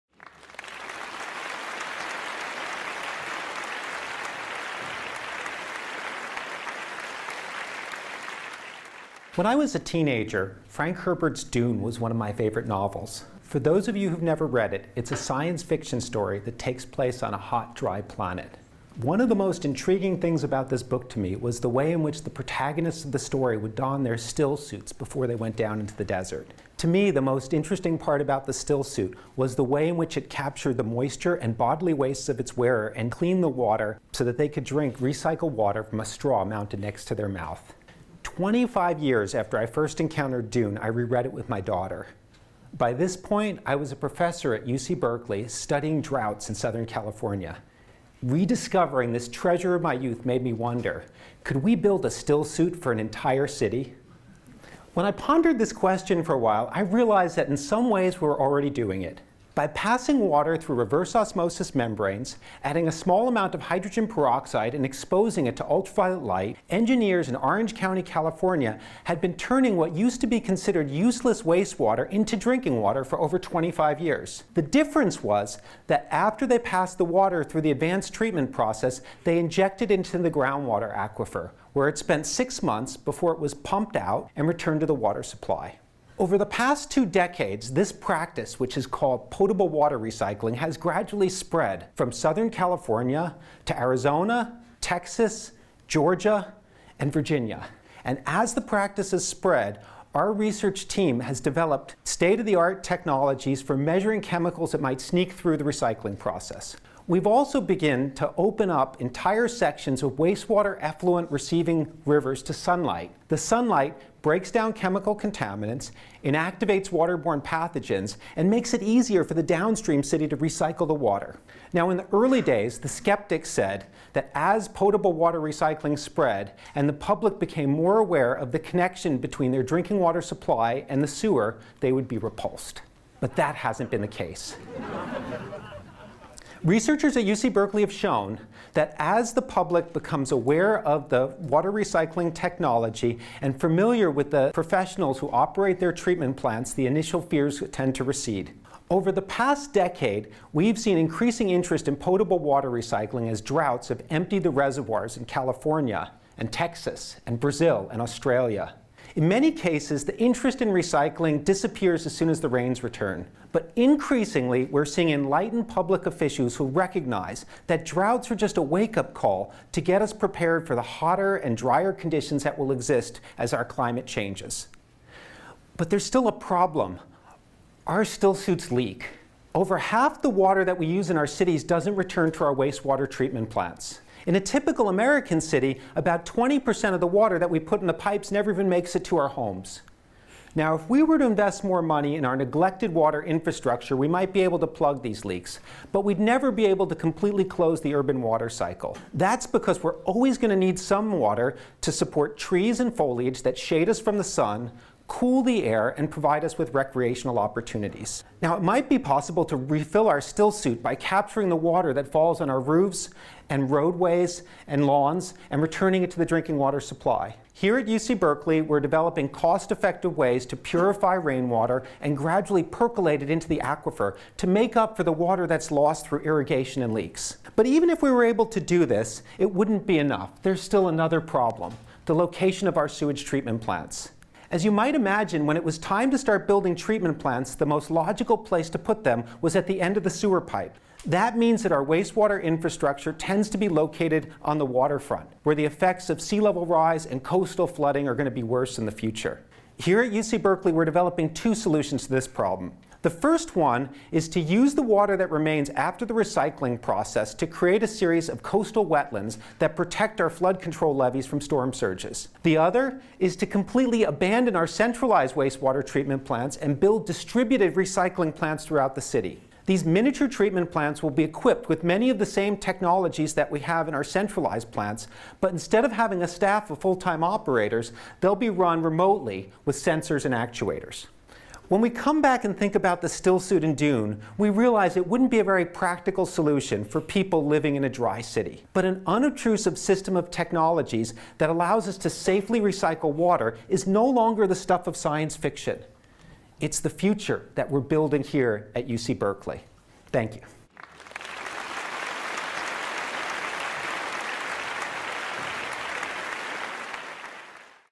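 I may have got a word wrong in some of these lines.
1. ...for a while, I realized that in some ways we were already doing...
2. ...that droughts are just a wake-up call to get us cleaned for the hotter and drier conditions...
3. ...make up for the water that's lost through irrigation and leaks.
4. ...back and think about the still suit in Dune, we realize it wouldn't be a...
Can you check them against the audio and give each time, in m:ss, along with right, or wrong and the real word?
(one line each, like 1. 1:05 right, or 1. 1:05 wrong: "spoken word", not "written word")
1. 0:56 right
2. 2:47 wrong: "prepared", not "cleaned"
3. 3:44 right
4. 4:42 right.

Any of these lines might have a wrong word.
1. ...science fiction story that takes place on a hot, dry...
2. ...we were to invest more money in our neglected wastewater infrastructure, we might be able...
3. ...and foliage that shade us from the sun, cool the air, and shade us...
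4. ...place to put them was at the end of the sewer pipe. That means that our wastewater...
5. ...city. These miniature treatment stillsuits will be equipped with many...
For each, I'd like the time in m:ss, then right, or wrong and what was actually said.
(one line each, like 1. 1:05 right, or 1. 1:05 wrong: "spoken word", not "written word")
1. 0:15 right
2. 3:10 wrong: "water", not "wastewater"
3. 3:22 wrong: "provide", not "shade"
4. 3:58 right
5. 4:29 wrong: "plants", not "stillsuits".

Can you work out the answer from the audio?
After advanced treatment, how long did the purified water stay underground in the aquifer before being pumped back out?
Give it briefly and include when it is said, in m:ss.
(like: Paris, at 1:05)
6 months, at 1:22.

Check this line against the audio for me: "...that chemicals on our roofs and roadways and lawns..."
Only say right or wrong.
wrong.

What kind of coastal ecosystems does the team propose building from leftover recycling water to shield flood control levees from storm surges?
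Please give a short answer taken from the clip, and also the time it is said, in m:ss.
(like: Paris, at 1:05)
coastal wetlands, at 4:18.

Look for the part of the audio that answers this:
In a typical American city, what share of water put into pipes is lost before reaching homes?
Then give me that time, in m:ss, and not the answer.
3:06.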